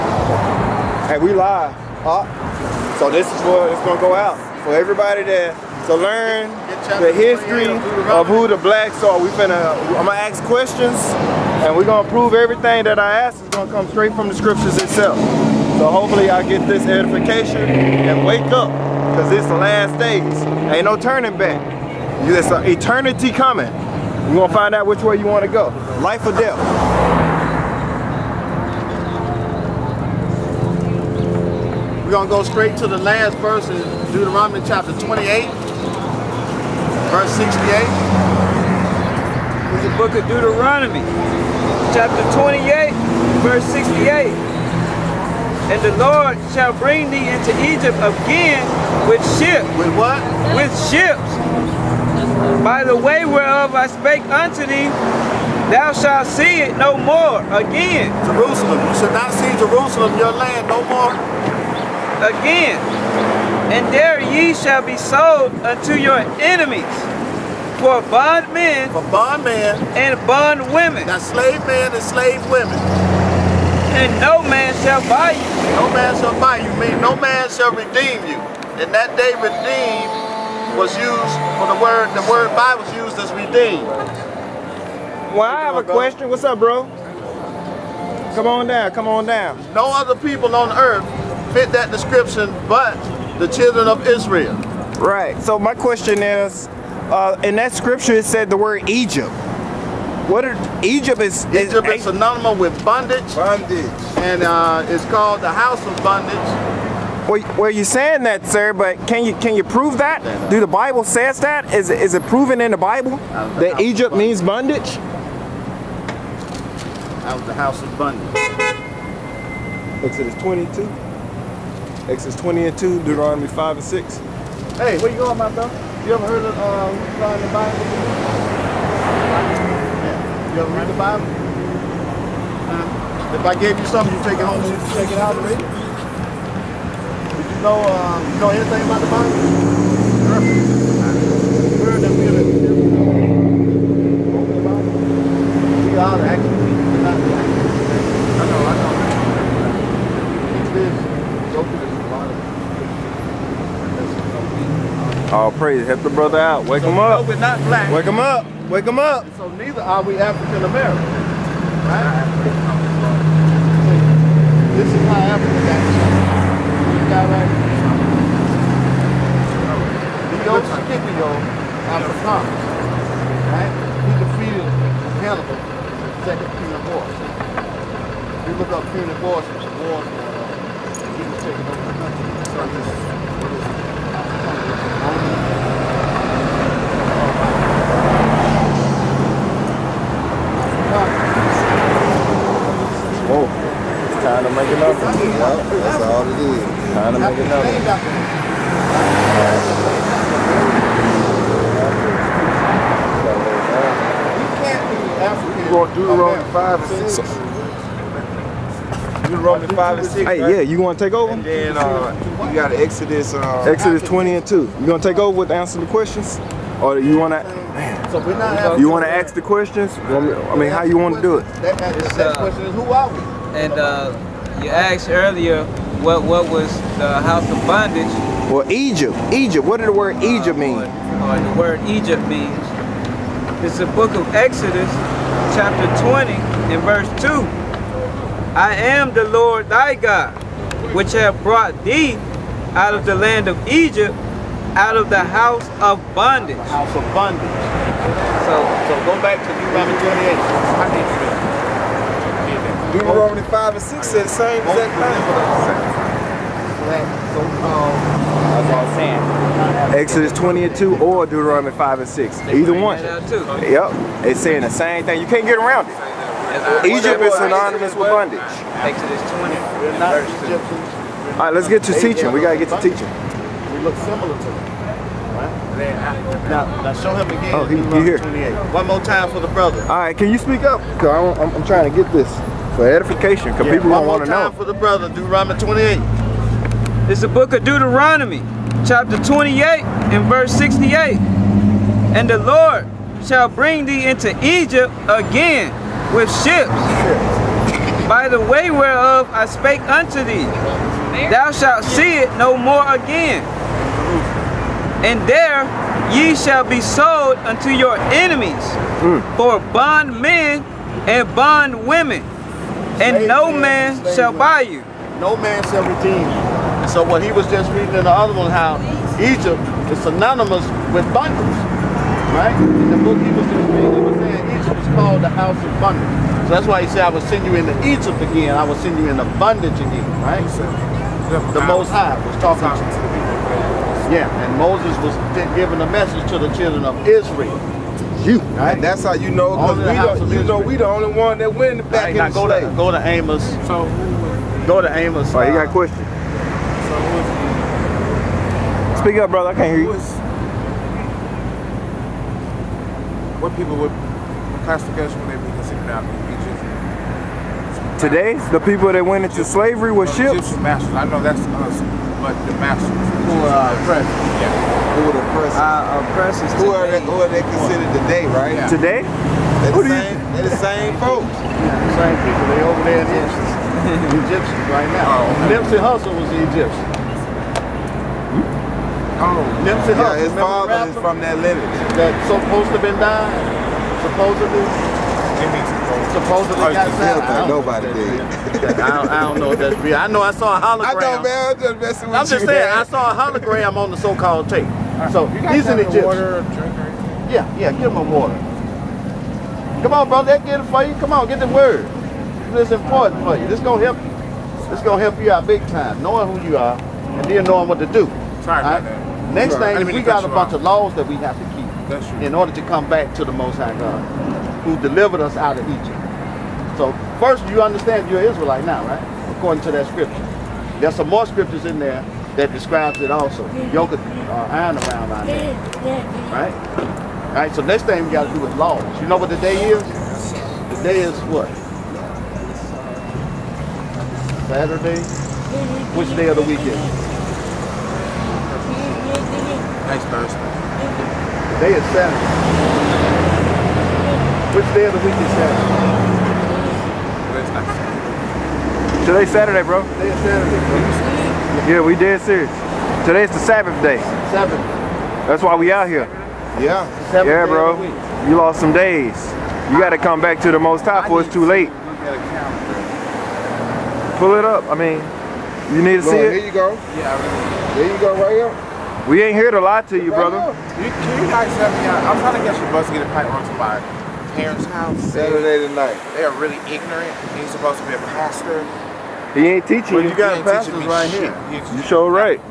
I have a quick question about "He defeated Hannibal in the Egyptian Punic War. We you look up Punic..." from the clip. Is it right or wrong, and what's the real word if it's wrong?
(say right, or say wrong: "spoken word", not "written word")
wrong: "Second", not "Egyptian".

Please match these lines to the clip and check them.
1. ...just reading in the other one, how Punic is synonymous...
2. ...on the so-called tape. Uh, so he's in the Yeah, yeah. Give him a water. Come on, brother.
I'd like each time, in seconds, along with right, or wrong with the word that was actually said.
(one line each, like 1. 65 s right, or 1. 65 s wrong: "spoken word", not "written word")
1. 317 s wrong: "Egypt", not "Punic"
2. 393 s right.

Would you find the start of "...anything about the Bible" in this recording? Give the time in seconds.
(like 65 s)
138 s.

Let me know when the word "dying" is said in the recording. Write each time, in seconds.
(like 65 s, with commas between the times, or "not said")
382 s.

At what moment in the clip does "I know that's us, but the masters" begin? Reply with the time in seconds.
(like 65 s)
360 s.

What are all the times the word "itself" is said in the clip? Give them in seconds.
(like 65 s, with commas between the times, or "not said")
14 s.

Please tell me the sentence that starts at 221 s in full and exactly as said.
That, that, that question is, who are we?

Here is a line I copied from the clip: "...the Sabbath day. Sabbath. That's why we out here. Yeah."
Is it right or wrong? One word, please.
right.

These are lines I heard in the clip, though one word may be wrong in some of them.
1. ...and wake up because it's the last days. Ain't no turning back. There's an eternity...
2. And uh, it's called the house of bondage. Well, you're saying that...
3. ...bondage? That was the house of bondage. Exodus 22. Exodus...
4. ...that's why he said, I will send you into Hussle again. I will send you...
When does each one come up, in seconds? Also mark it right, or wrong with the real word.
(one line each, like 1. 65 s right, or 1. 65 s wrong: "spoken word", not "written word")
1. 17 s right
2. 104 s right
3. 114 s right
4. 326 s wrong: "Egypt", not "Hussle".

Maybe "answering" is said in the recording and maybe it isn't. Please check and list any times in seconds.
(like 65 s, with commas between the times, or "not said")
215 s.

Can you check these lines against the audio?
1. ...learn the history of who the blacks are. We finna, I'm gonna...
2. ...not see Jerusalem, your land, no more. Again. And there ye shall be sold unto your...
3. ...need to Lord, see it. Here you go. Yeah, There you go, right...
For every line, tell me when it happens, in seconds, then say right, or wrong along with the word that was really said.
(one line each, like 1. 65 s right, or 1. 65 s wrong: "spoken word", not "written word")
1. 5 s right
2. 59 s right
3. 465 s right.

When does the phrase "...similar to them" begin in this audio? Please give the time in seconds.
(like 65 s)
274 s.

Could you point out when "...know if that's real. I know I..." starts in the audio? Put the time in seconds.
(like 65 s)
389 s.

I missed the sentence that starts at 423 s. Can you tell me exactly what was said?
Yoke uh, iron around on there.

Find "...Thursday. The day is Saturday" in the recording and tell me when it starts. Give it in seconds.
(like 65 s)
440 s.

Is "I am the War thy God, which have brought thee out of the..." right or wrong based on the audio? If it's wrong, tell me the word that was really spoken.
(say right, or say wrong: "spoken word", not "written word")
wrong: "Lord", not "War".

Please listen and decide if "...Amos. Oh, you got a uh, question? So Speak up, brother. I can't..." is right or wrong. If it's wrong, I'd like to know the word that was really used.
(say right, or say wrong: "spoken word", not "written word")
right.